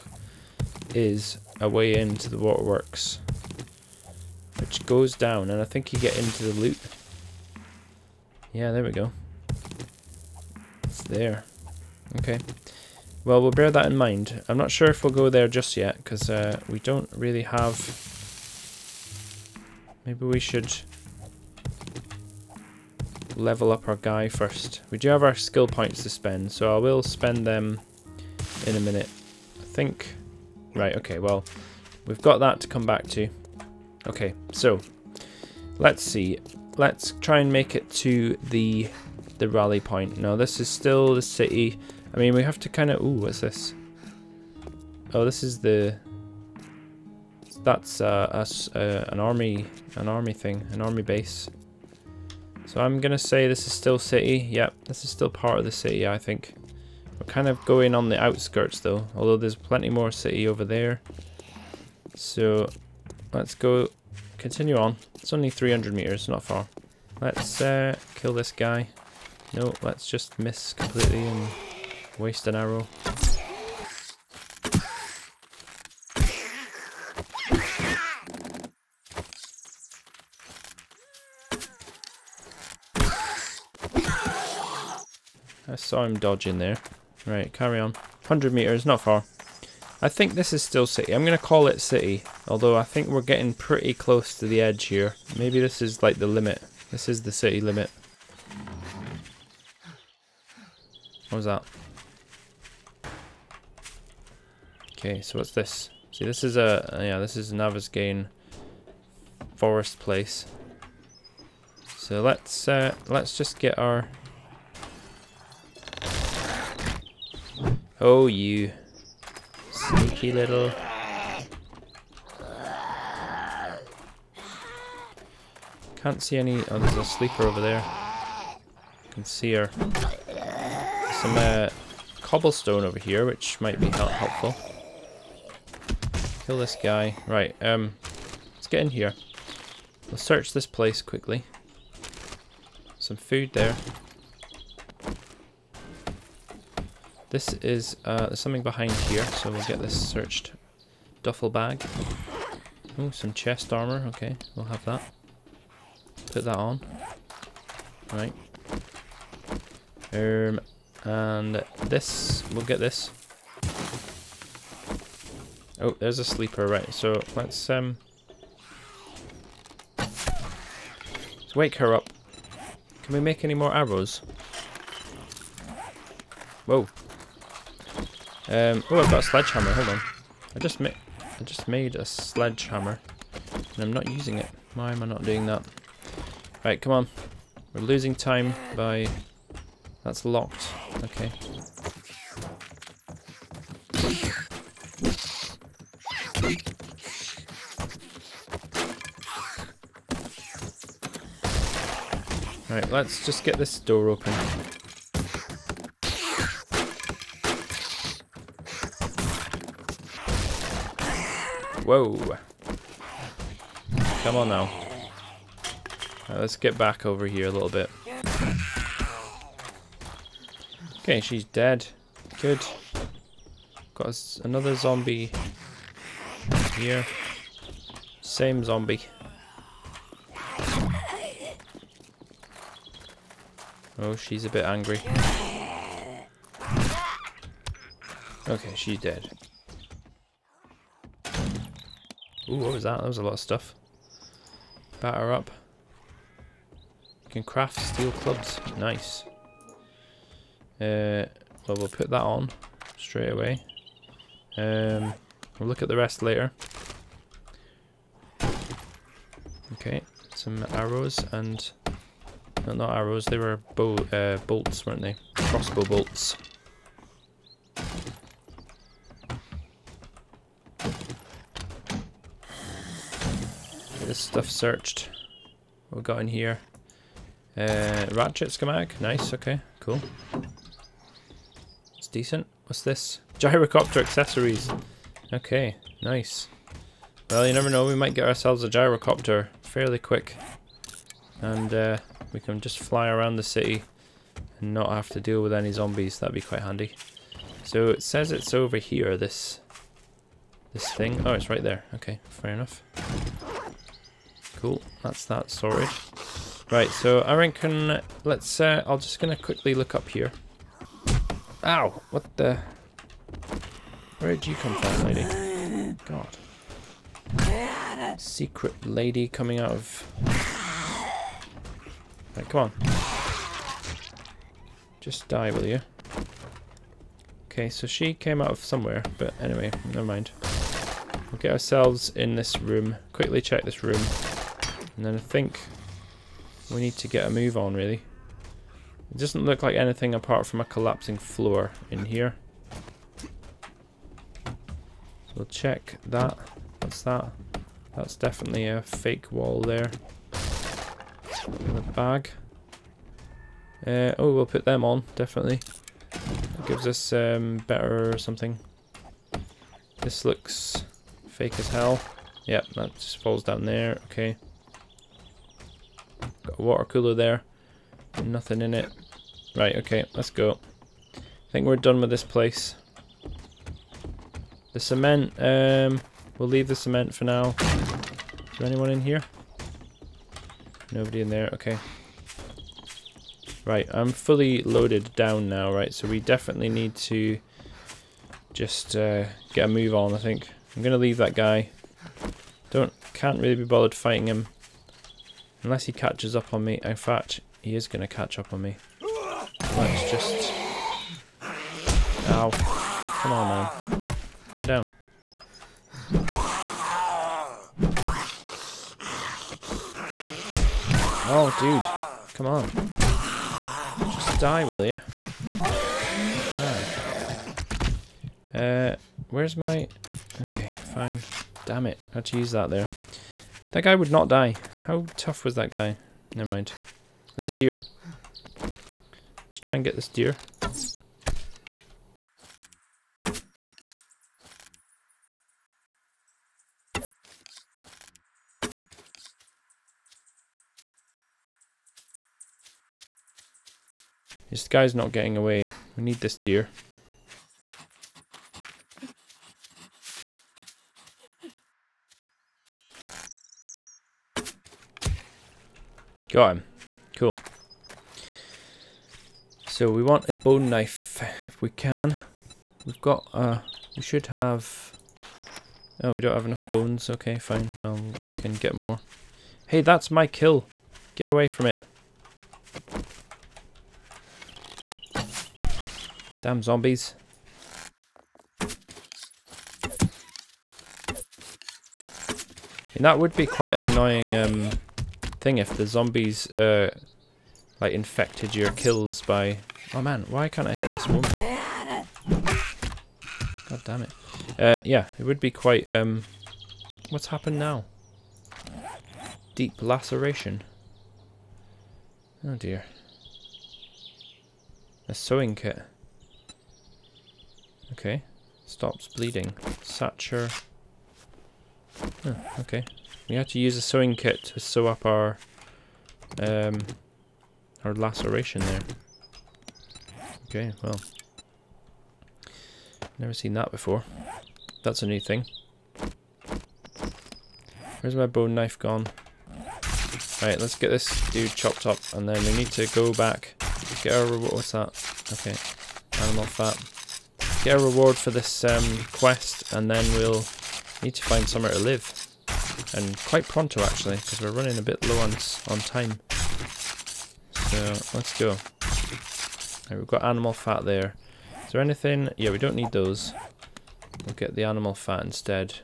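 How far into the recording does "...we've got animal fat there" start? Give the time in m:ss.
9:09.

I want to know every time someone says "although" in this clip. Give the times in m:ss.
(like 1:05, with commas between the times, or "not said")
0:59, 1:32.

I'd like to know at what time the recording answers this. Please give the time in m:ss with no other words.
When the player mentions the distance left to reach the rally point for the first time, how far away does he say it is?
1:05.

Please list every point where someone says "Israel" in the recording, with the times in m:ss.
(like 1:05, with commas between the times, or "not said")
not said.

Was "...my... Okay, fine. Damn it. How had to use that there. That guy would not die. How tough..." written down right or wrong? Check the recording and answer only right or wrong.
right.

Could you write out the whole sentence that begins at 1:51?
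So let's, uh, let's just get our...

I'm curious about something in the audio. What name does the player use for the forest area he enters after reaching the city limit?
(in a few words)
Navezgane.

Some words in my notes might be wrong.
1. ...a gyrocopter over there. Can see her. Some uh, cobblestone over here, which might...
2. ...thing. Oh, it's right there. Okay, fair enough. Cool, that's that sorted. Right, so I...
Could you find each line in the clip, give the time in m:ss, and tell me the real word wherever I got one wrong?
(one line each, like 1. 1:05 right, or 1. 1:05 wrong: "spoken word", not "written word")
1. 2:06 wrong: "sleeper", not "gyrocopter"
2. 5:00 right.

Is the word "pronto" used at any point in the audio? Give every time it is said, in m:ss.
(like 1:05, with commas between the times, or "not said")
9:03.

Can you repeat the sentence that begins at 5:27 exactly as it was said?
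Okay, so she came out of somewhere, but anyway, never mind.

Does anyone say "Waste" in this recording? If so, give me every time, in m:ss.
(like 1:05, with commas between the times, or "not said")
1:12.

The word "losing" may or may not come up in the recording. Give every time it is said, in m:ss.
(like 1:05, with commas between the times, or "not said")
3:07.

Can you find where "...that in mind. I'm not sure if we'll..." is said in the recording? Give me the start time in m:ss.
0:13.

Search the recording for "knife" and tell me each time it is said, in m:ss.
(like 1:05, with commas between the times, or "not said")
7:40, 8:48.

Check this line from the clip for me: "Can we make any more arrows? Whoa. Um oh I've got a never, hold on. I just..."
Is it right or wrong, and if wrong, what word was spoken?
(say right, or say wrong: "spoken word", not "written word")
wrong: "sledgehammer", not "never".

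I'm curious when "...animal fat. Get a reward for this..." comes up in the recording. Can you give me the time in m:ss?
8:56.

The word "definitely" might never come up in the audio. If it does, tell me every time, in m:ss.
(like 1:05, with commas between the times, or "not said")
5:48, 5:55, 6:26.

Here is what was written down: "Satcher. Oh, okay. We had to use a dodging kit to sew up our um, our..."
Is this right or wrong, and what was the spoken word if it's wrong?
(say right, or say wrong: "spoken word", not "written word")
wrong: "sewing", not "dodging".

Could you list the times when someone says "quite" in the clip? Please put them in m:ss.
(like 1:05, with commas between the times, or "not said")
4:56, 8:03, 8:15, 9:03.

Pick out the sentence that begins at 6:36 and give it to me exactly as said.
In fact, he is going to catch up on me.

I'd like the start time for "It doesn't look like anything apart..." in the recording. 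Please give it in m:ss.
5:39.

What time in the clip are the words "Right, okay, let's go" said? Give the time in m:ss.
6:09.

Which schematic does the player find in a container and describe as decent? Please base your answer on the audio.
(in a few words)
ratchet.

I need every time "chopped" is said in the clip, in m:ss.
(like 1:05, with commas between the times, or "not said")
8:51.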